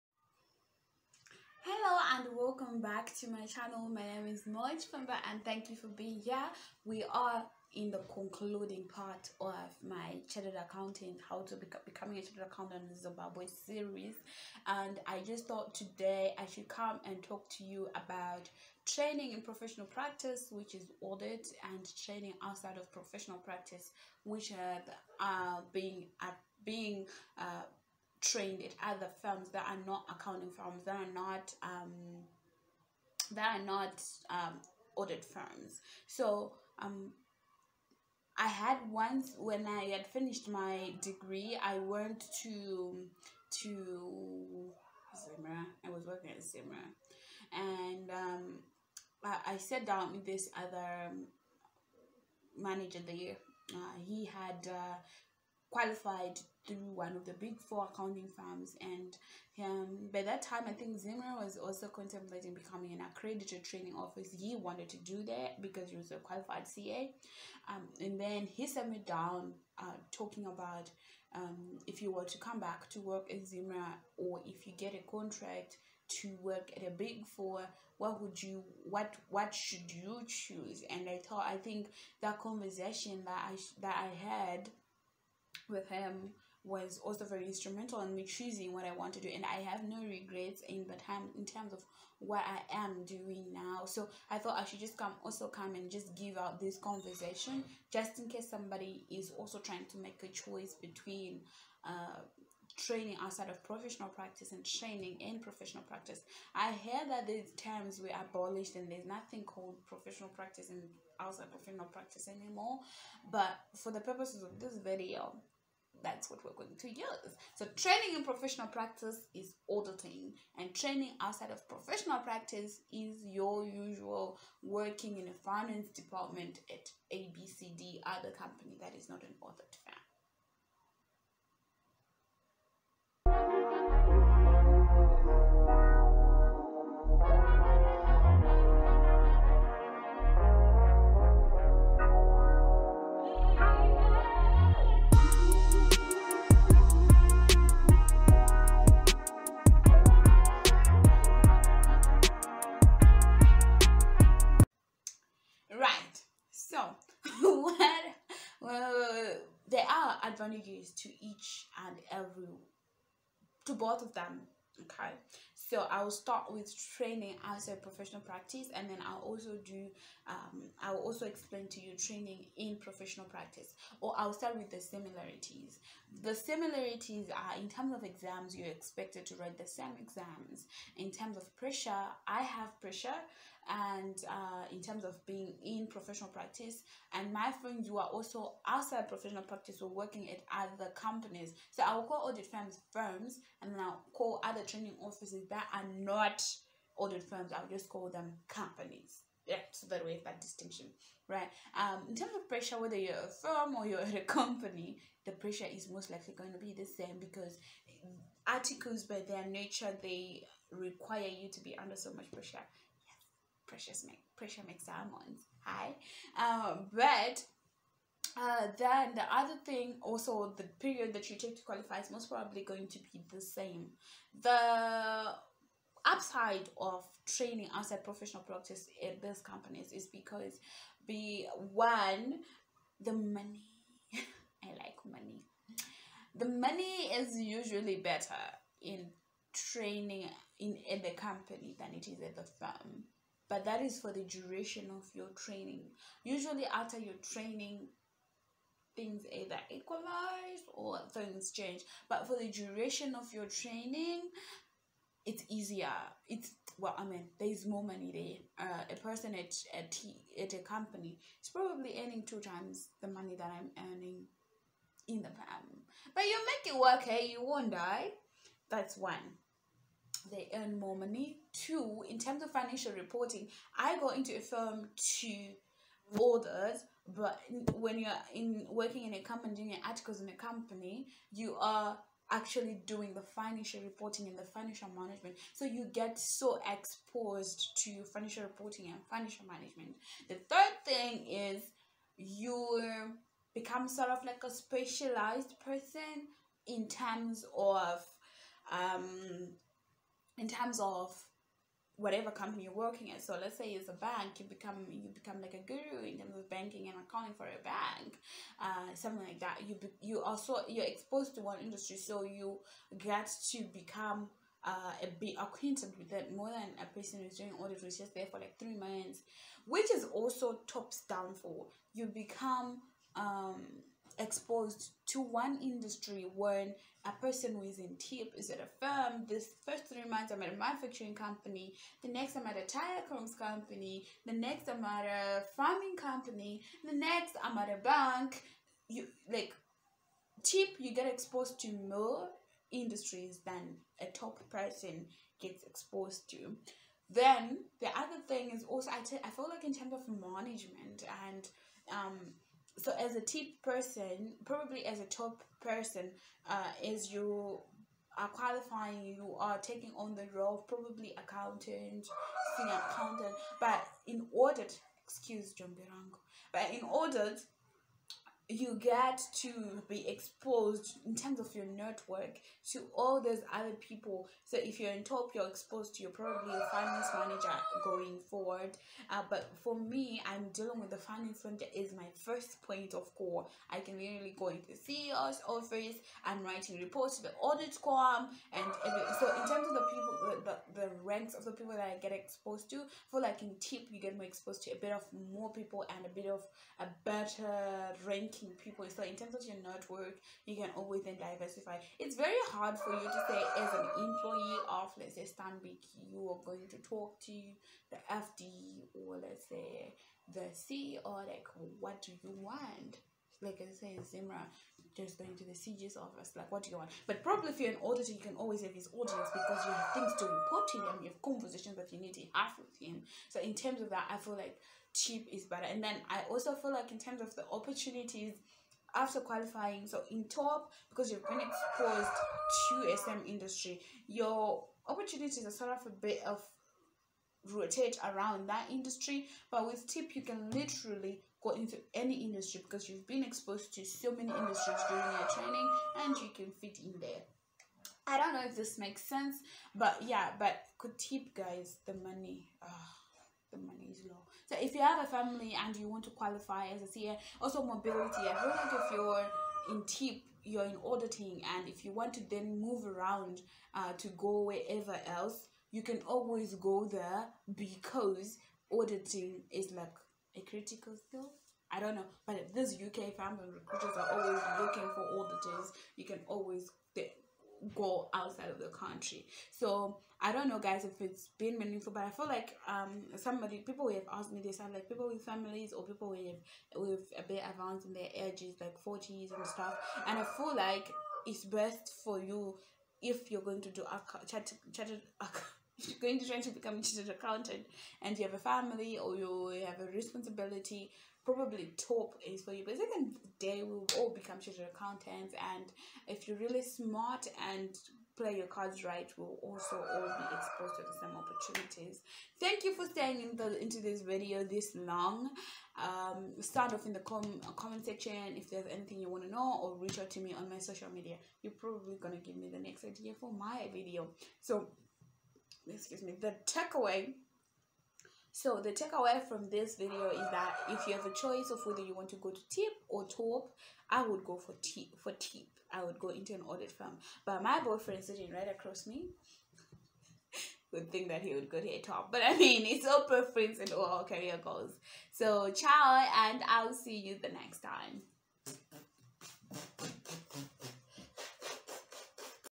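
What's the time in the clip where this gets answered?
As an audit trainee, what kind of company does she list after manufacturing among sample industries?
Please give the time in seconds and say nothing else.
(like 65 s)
332 s.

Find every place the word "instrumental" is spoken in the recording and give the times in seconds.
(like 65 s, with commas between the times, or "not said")
87 s.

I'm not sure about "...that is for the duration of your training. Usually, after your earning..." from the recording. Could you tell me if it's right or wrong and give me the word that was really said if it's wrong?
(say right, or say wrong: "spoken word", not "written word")
wrong: "training", not "earning".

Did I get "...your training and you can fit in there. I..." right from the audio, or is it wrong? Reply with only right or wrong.
right.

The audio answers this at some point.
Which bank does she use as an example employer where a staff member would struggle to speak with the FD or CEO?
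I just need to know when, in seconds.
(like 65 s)
405 s.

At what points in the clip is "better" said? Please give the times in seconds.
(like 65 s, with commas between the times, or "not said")
237 s, 397 s, 425 s.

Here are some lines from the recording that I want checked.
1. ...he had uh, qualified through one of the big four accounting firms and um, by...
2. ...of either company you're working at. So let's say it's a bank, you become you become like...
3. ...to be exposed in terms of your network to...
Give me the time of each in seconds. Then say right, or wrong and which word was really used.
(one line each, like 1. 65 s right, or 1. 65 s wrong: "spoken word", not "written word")
1. 54 s right
2. 300 s wrong: "whatever", not "either"
3. 369 s right.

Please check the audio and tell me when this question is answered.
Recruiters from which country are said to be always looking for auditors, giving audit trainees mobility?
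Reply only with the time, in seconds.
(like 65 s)
472 s.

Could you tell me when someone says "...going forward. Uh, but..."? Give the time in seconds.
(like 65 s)
377 s.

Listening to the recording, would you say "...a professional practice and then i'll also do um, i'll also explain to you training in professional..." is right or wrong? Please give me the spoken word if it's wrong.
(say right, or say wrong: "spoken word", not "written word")
right.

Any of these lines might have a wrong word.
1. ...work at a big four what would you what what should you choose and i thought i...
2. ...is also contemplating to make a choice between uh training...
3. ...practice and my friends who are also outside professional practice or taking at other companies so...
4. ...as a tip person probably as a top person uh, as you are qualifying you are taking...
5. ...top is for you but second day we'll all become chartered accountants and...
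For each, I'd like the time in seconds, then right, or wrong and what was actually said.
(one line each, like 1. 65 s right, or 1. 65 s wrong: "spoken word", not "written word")
1. 76 s right
2. 99 s wrong: "trying", not "contemplating"
3. 186 s wrong: "working", not "taking"
4. 352 s right
5. 501 s right.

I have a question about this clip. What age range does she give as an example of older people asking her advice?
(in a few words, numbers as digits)
Forties.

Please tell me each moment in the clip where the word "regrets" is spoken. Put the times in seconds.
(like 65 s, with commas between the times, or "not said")
90 s.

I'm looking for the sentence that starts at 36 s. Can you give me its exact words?
So um, I had once when I had finished my degree, I went to to Zimra.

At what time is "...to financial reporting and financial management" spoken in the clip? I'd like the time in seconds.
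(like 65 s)
287 s.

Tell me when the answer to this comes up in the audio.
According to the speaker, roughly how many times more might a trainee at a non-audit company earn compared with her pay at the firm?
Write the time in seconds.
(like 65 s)
262 s.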